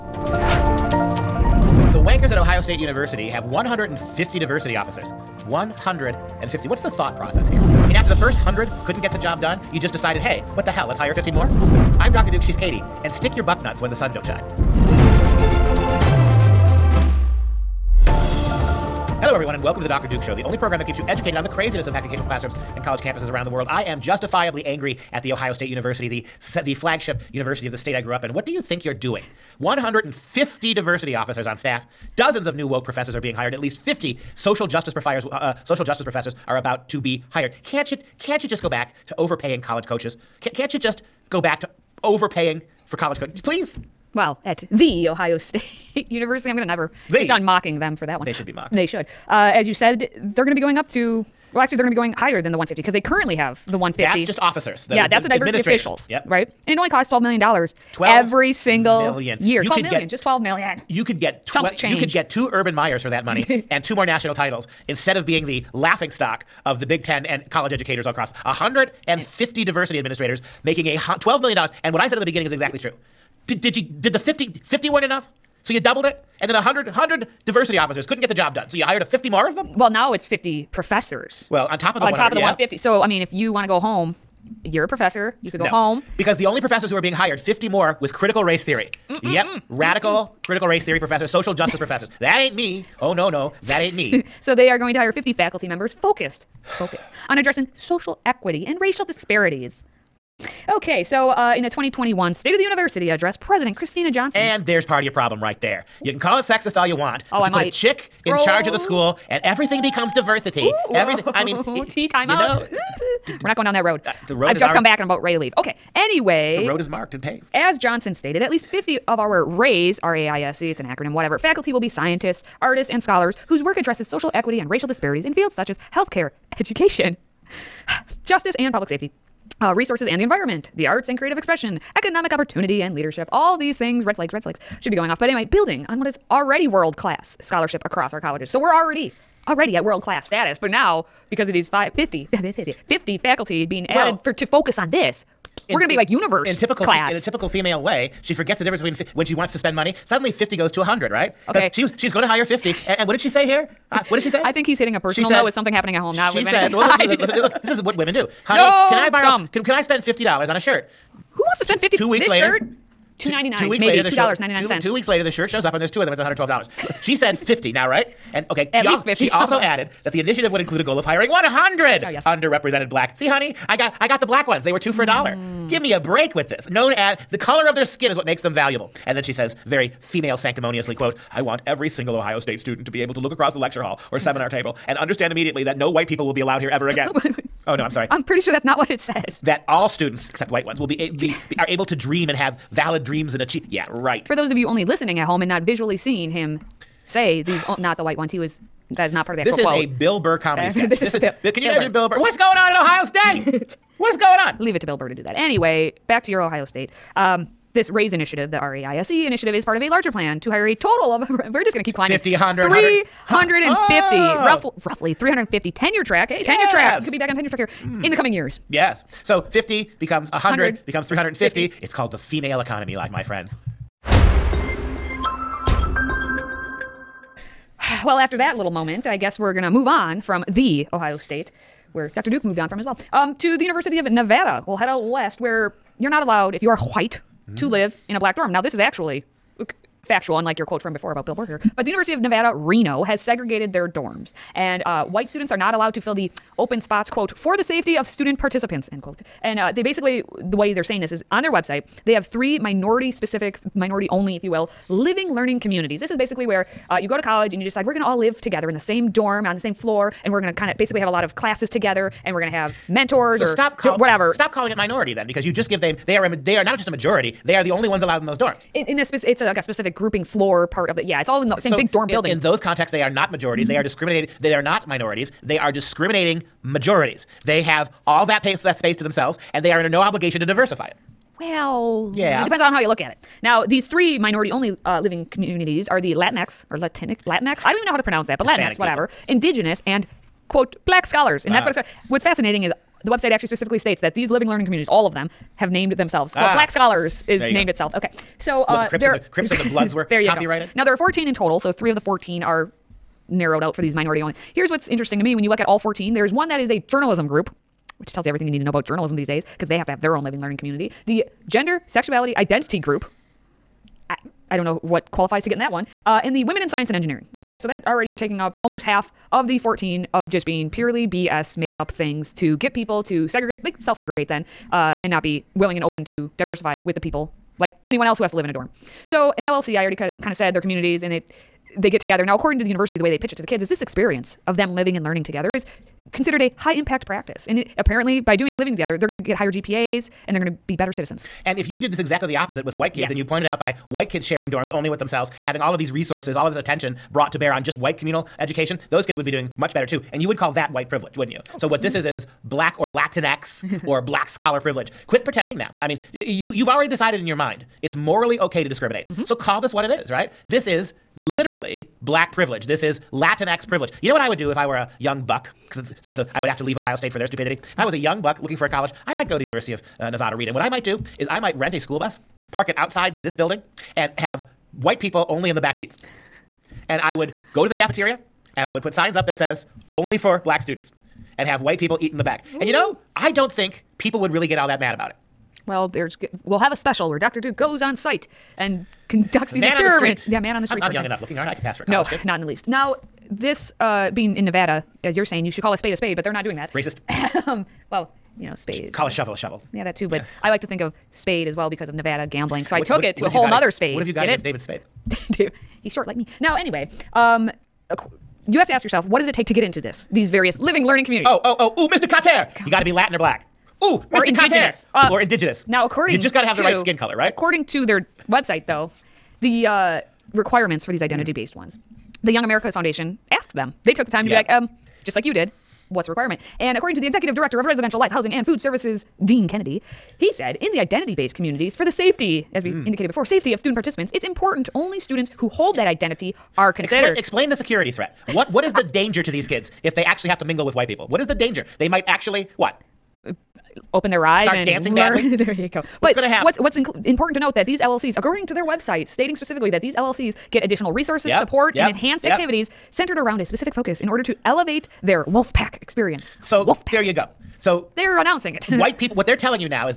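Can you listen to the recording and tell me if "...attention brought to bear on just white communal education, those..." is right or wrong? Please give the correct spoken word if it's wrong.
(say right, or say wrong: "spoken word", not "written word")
right.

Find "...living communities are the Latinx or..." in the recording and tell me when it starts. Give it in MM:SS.
04:44.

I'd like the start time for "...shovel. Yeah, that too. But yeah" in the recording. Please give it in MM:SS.
06:39.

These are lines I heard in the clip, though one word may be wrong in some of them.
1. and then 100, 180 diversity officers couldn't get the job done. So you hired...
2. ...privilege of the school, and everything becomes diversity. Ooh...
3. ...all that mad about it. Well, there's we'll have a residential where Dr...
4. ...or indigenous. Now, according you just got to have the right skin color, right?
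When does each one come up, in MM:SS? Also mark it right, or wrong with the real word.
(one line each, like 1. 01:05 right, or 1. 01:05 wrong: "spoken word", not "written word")
1. 01:16 wrong: "100", not "180"
2. 01:48 wrong: "charge", not "privilege"
3. 06:24 wrong: "special", not "residential"
4. 06:55 right.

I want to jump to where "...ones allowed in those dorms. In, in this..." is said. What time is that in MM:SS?
04:27.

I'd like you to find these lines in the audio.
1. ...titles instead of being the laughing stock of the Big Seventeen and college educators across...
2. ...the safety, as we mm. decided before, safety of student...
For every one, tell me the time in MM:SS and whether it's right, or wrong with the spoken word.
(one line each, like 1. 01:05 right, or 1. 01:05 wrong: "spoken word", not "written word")
1. 01:04 wrong: "Ten", not "Seventeen"
2. 07:11 wrong: "indicated", not "decided".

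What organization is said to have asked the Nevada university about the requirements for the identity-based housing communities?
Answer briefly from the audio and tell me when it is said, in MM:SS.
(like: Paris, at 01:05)
Young Americas Foundation, at 07:02.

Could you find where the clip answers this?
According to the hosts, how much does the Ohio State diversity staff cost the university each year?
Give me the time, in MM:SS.
00:57.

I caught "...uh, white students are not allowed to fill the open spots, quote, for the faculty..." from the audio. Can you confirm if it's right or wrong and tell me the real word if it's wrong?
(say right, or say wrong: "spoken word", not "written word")
wrong: "safety", not "faculty".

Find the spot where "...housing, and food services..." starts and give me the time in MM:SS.
07:08.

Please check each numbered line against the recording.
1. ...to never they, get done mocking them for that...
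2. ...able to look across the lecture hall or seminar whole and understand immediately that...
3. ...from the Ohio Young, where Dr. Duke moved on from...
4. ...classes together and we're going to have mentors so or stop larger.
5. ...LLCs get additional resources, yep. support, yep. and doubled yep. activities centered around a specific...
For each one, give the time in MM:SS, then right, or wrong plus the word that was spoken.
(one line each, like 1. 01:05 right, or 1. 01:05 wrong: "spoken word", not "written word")
1. 00:46 right
2. 03:03 wrong: "table", not "whole"
3. 03:50 wrong: "State", not "Young"
4. 04:21 wrong: "whatever", not "larger"
5. 07:29 wrong: "enhanced", not "doubled".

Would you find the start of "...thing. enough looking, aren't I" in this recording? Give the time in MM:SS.
06:31.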